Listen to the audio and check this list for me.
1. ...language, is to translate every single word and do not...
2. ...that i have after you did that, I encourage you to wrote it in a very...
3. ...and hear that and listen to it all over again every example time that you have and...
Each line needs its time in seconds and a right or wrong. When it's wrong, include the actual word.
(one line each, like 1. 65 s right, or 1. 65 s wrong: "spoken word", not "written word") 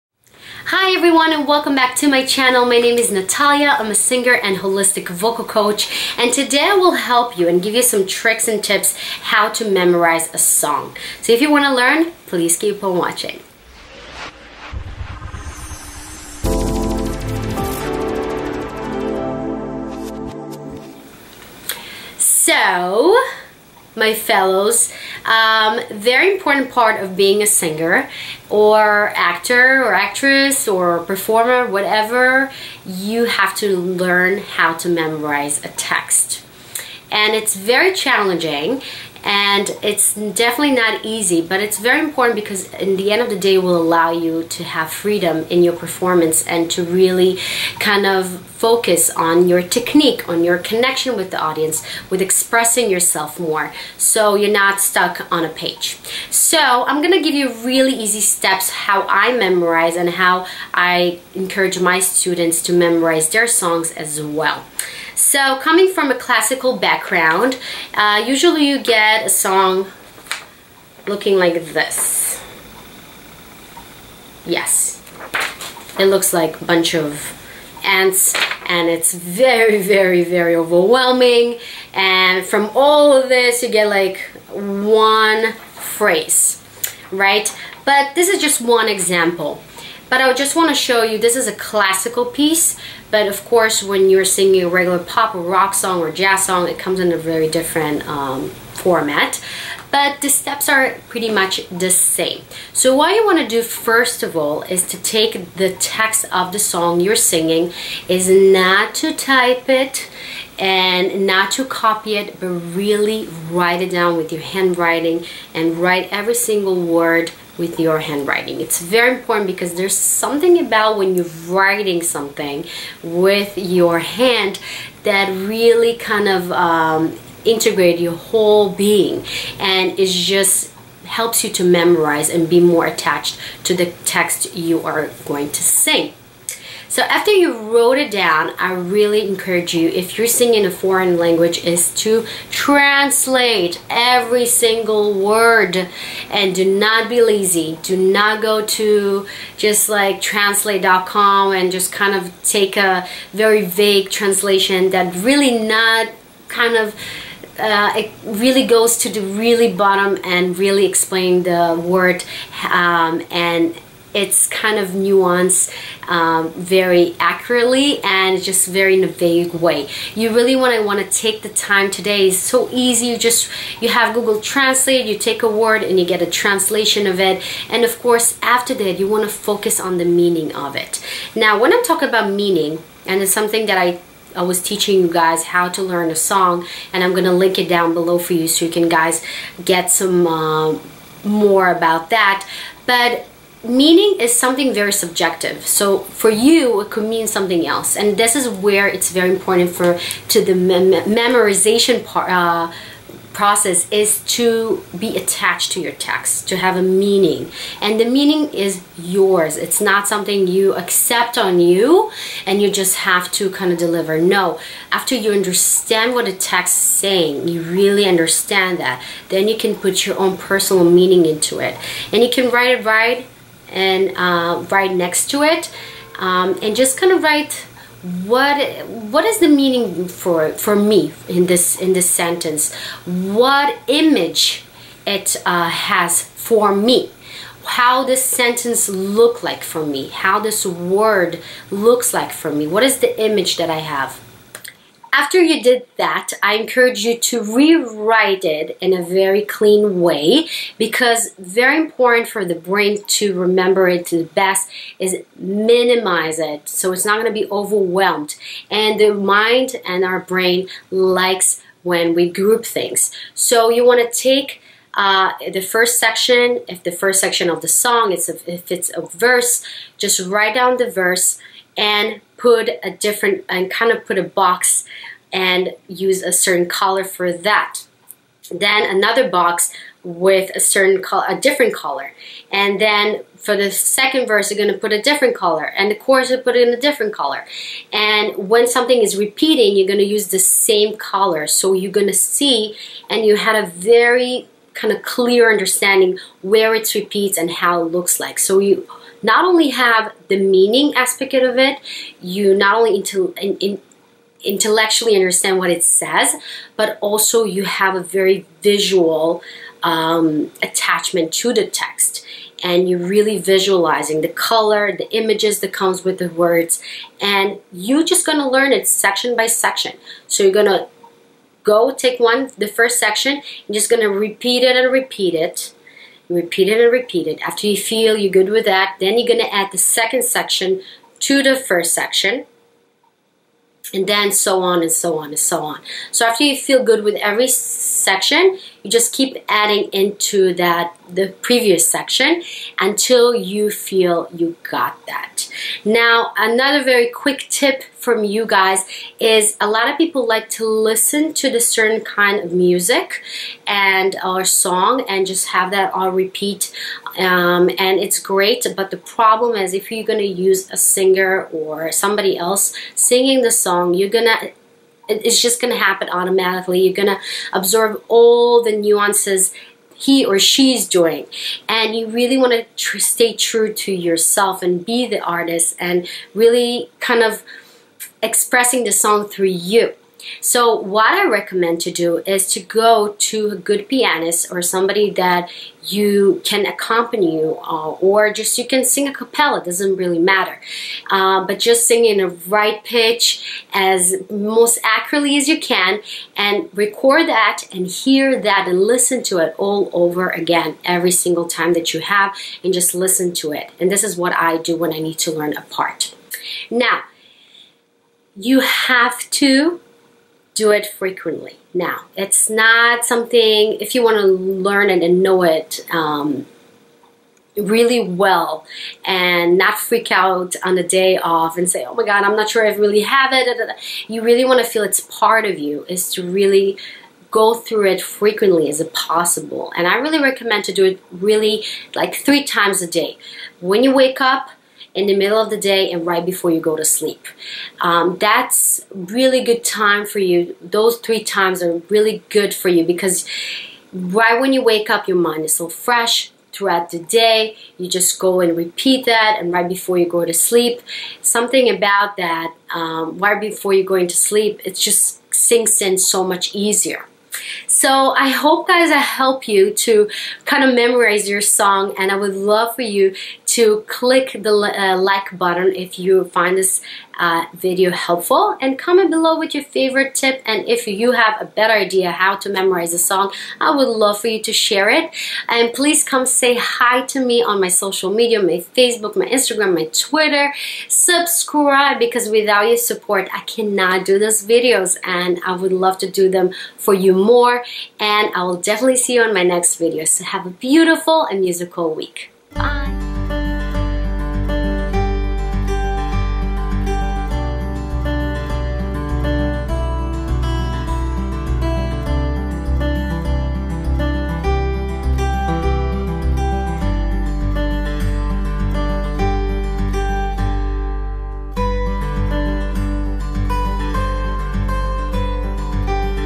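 1. 141 s right
2. 243 s wrong: "rewrite", not "wrote"
3. 397 s wrong: "single", not "example".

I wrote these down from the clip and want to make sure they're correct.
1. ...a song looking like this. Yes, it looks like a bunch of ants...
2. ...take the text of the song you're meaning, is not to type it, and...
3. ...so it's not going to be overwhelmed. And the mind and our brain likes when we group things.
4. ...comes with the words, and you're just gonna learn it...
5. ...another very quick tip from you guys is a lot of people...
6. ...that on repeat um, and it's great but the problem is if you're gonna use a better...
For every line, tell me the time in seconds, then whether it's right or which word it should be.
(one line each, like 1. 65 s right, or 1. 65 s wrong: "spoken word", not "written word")
1. 69 s right
2. 105 s wrong: "singing", not "meaning"
3. 256 s right
4. 315 s right
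5. 346 s right
6. 355 s wrong: "singer", not "better".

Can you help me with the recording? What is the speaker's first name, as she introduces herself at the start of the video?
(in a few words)
Natalia.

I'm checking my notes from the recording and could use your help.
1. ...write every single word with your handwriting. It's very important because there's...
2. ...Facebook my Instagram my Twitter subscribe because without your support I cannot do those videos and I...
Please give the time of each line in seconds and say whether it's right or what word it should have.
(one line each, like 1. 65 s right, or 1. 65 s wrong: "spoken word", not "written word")
1. 115 s right
2. 478 s right.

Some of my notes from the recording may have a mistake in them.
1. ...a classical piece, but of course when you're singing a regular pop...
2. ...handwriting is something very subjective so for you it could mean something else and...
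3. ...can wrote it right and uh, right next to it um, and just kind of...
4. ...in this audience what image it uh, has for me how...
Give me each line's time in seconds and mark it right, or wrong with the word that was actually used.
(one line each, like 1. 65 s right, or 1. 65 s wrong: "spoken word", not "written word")
1. 91 s right
2. 193 s wrong: "meaning", not "handwriting"
3. 222 s wrong: "write", not "wrote"
4. 231 s wrong: "sentence", not "audience".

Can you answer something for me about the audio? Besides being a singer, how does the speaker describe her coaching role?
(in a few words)
holistic vocal coach.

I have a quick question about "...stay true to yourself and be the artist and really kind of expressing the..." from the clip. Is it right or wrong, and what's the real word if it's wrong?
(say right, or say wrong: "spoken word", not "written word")
right.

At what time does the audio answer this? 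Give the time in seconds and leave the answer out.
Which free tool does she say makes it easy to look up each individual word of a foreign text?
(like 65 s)
174 s.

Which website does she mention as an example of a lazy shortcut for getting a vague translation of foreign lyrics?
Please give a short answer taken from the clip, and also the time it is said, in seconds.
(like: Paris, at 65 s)
translate.com, at 150 s.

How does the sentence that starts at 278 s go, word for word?
Then another box with a certain color, a different color.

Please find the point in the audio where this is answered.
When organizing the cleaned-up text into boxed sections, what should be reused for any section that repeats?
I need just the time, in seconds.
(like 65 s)
290 s.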